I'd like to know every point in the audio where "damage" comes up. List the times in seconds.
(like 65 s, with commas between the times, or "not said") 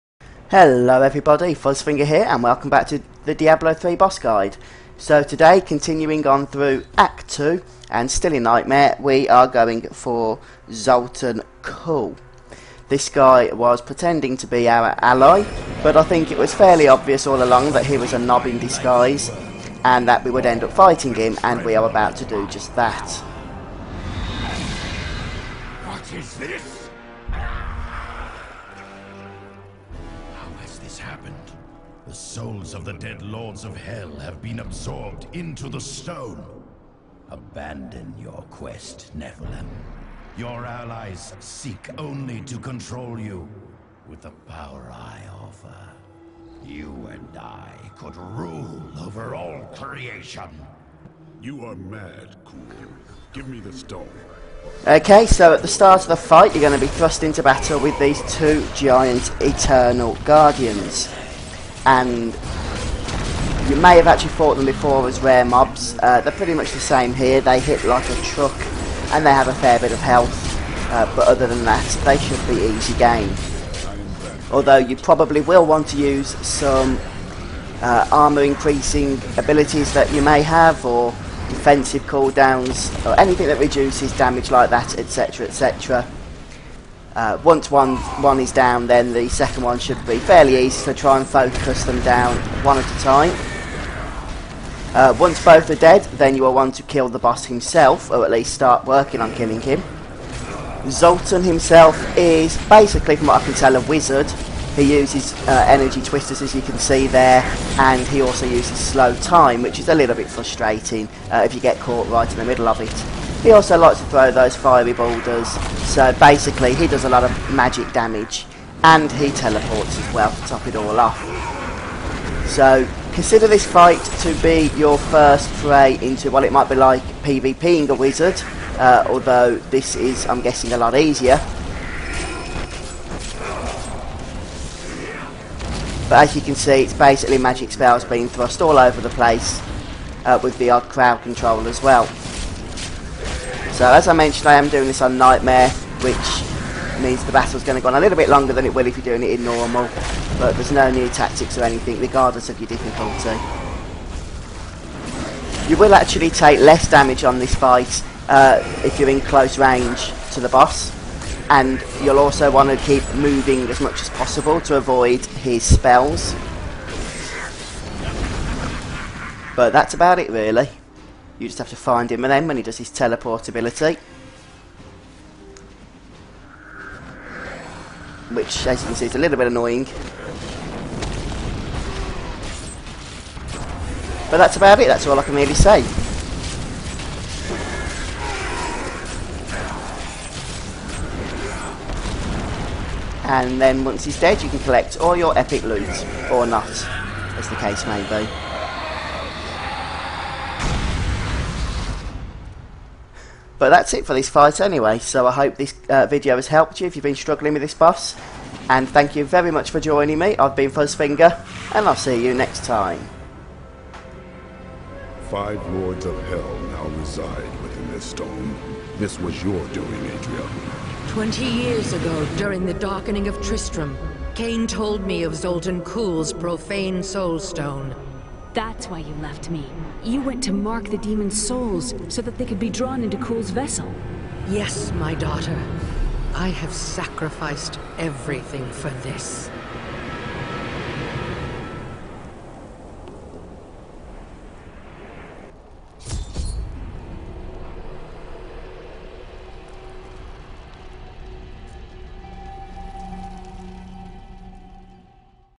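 84 s, 117 s, 156 s.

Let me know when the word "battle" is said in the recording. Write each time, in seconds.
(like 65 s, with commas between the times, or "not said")
57 s, 147 s.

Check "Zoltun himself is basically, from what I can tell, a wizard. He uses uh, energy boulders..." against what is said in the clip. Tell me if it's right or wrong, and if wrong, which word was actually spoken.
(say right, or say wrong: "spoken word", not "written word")
wrong: "twisters", not "boulders".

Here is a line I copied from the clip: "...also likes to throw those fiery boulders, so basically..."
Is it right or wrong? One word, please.
right.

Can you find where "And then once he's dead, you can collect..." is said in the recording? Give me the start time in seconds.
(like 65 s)
193 s.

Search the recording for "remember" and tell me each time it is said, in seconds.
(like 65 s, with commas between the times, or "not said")
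not said.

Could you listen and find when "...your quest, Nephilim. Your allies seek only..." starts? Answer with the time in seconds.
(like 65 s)
38 s.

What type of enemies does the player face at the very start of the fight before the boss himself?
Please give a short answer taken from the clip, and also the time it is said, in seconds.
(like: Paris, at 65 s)
Eternal Guardians, at 59 s.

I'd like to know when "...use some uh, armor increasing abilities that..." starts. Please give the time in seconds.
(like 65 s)
75 s.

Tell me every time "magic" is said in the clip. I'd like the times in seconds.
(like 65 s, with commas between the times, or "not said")
117 s, 137 s.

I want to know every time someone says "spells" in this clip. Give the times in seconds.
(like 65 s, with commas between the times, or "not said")
137 s, 165 s.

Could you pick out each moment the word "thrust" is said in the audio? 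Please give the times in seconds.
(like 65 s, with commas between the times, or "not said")
56 s, 138 s.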